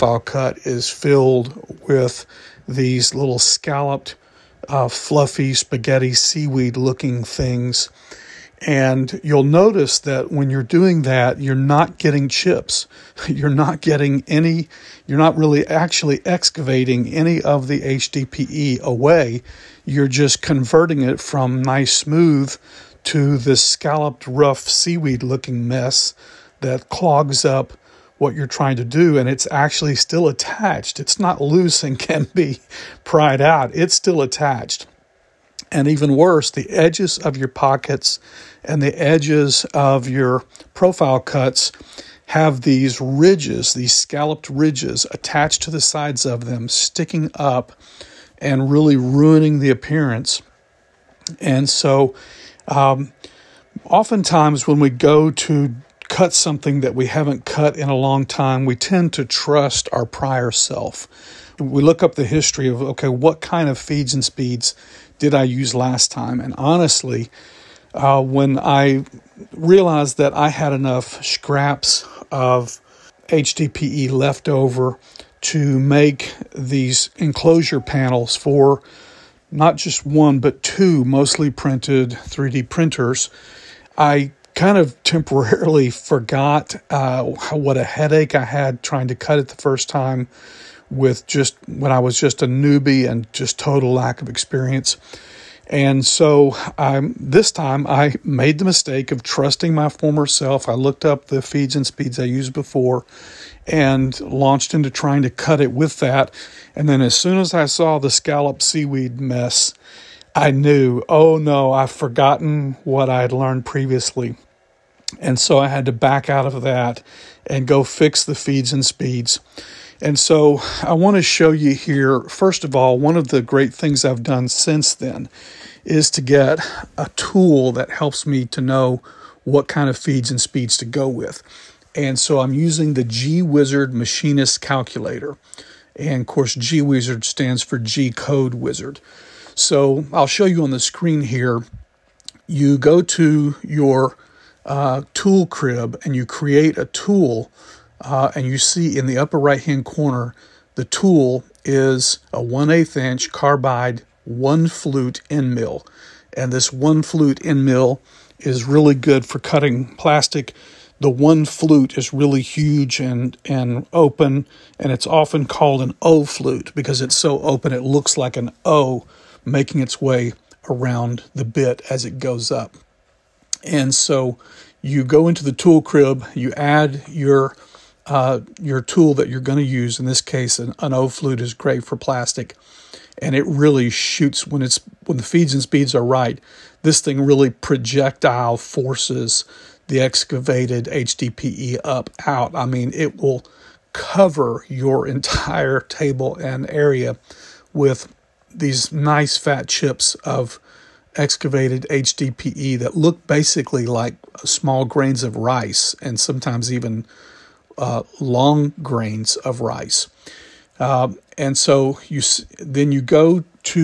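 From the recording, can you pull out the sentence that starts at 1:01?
We look up the history of, okay, what kind of feeds and speeds did I use last time?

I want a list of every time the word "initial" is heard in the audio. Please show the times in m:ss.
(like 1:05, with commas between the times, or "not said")
not said.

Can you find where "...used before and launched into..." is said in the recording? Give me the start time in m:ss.
1:42.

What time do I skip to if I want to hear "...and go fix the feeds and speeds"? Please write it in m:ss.
1:57.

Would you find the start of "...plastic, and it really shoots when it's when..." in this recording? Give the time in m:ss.
3:01.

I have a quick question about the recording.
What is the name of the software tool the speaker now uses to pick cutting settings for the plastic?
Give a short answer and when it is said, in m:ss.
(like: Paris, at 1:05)
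G-Wizard Machinist Calculator, at 2:13.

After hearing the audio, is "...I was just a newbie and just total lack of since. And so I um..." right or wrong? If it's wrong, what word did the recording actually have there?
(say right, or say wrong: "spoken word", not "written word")
wrong: "experience", not "since".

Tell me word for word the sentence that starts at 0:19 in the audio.
You're just converting it from nice smooth to this scalloped, rough, seaweed looking mess that clogs up what you're trying to do.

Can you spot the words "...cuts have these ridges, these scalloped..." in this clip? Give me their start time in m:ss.
0:41.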